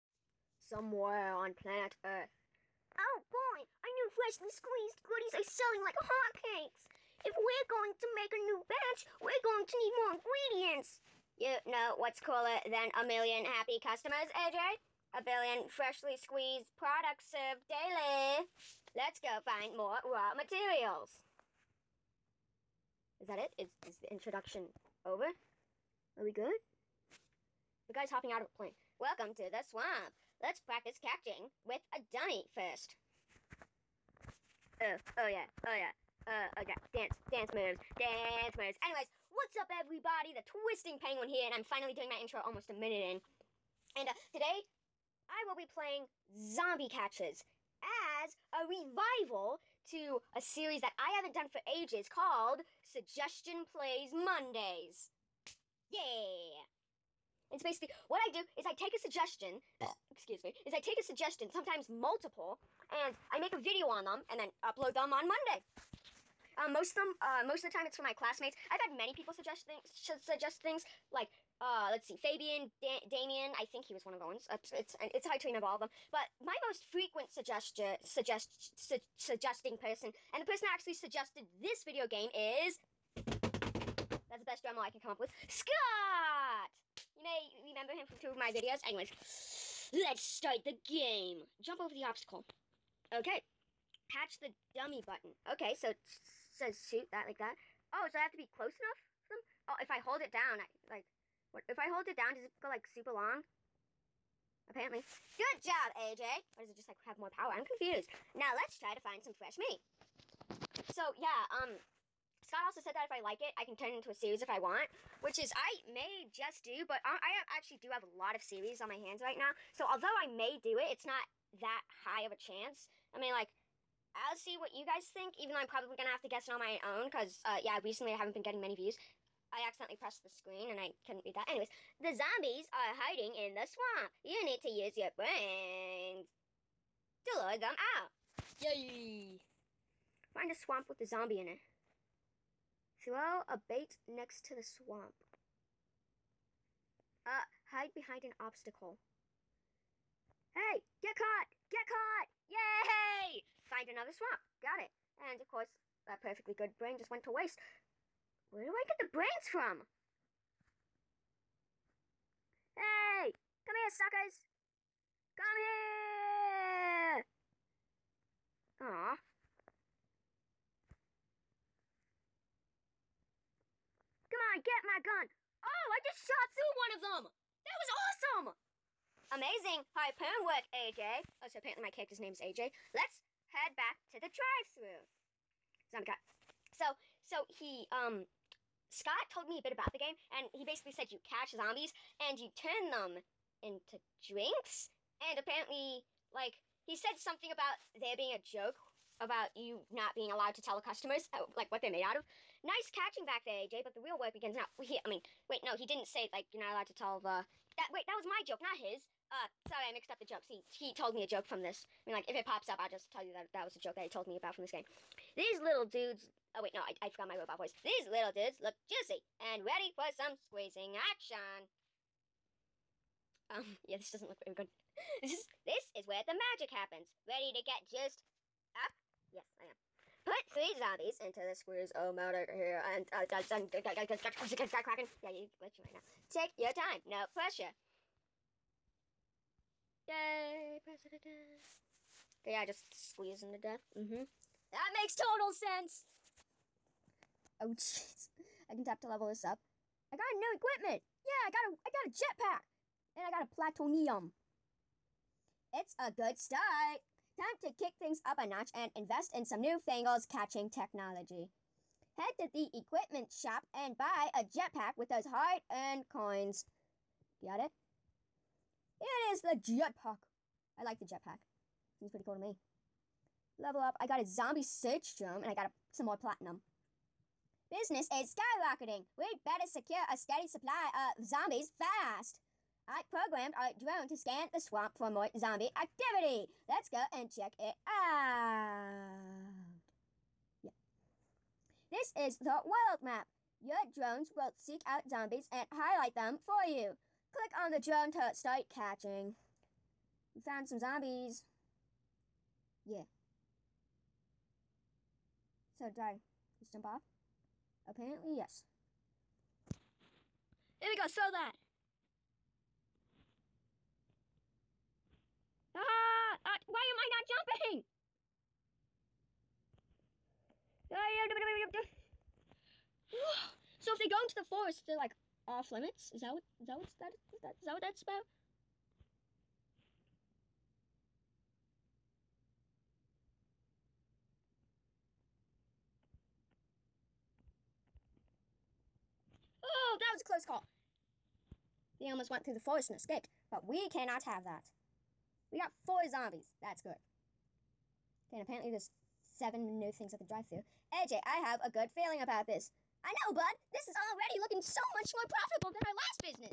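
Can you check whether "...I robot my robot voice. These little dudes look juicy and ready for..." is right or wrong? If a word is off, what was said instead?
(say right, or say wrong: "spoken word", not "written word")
wrong: "forgot", not "robot".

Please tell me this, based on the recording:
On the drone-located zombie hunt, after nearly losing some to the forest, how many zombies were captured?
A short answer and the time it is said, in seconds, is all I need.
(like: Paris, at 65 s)
4, at 345 s.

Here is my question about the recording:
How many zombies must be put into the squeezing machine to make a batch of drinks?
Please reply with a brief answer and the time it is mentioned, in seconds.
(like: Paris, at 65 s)
3, at 230 s.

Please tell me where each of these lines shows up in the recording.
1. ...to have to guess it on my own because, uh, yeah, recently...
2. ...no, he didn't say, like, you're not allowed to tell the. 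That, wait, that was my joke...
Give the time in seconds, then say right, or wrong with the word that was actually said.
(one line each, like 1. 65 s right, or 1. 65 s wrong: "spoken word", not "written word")
1. 126 s right
2. 205 s right.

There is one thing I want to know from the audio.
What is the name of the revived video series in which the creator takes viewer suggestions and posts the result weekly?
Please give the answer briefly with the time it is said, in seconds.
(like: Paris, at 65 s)
Suggestion Plays Mondays, at 52 s.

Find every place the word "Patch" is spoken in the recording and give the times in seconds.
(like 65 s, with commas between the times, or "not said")
94 s.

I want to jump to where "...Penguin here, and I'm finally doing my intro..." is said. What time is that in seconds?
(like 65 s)
40 s.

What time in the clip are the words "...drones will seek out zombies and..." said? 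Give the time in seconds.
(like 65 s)
293 s.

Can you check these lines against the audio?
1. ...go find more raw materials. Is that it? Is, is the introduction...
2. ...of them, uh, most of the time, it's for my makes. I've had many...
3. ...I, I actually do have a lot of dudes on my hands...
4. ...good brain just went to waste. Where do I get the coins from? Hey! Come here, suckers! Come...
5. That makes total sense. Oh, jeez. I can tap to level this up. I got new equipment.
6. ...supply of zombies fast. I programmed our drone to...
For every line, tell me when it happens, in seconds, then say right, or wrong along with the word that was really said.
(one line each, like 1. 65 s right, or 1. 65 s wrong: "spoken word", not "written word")
1. 19 s right
2. 66 s wrong: "classmates", not "makes"
3. 117 s wrong: "series", not "dudes"
4. 156 s wrong: "brains", not "coins"
5. 244 s right
6. 280 s right.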